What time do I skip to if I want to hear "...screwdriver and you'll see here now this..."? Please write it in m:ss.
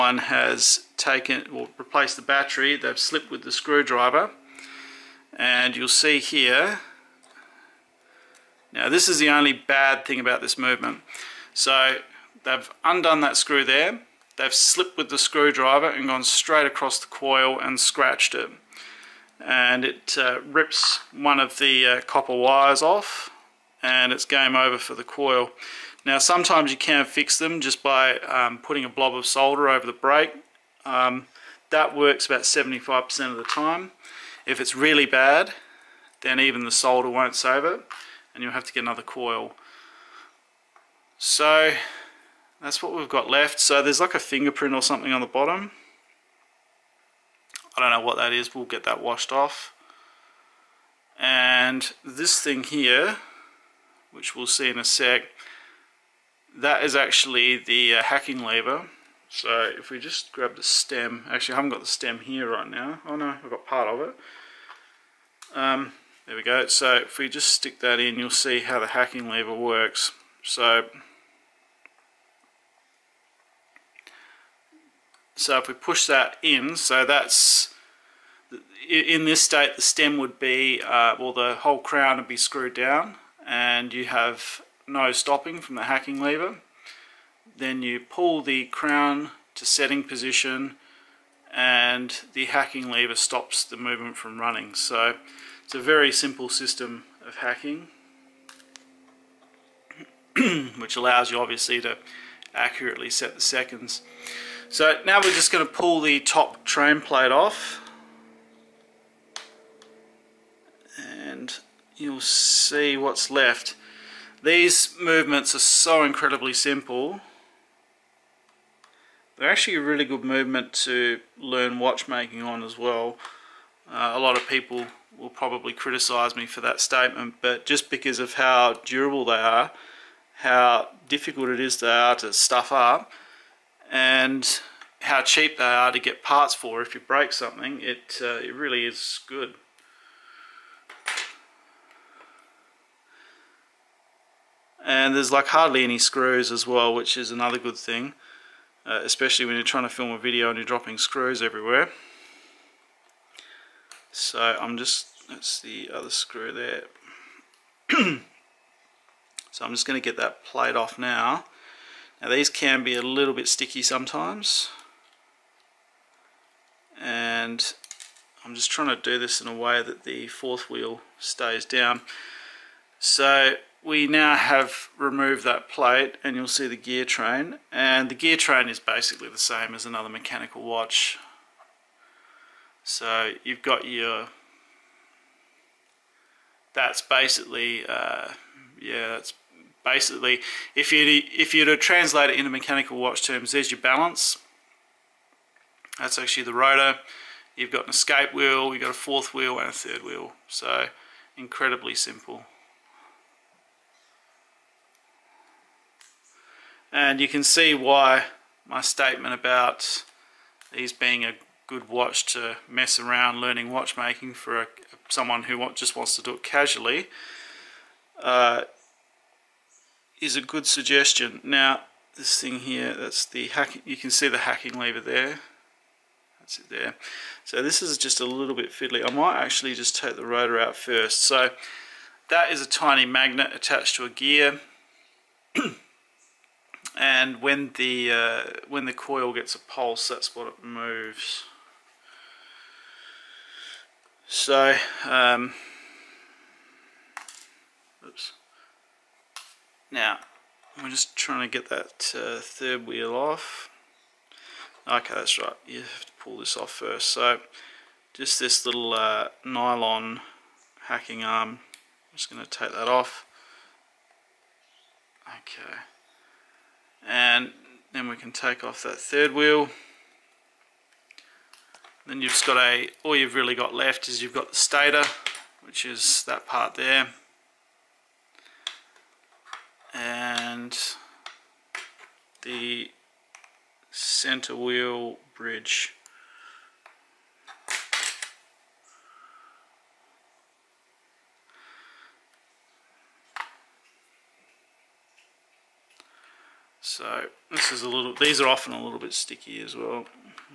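0:03.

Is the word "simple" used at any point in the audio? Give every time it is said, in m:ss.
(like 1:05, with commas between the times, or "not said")
1:36, 1:56, 3:21.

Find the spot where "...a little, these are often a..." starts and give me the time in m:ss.
4:57.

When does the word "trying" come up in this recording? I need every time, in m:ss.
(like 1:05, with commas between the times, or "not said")
2:29, 2:48, 4:11.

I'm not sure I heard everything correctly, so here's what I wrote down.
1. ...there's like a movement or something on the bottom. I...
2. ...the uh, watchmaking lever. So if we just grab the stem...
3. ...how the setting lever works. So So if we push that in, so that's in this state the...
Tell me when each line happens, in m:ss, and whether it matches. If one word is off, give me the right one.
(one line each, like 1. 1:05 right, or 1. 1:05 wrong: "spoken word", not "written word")
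1. 0:43 wrong: "fingerprint", not "movement"
2. 0:57 wrong: "hacking", not "watchmaking"
3. 1:08 wrong: "hacking", not "setting".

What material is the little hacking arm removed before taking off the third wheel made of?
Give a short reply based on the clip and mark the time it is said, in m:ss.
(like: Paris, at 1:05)
nylon, at 4:19.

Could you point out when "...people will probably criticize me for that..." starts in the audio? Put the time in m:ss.
2:04.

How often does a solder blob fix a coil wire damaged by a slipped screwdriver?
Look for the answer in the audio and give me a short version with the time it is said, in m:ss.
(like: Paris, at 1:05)
75%, at 0:32.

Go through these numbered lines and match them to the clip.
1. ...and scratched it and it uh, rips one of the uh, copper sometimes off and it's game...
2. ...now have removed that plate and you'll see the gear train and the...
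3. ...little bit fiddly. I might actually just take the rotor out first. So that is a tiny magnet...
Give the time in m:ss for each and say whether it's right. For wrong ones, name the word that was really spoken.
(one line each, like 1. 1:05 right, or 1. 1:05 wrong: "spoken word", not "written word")
1. 0:17 wrong: "wires", not "sometimes"
2. 2:54 right
3. 3:48 right.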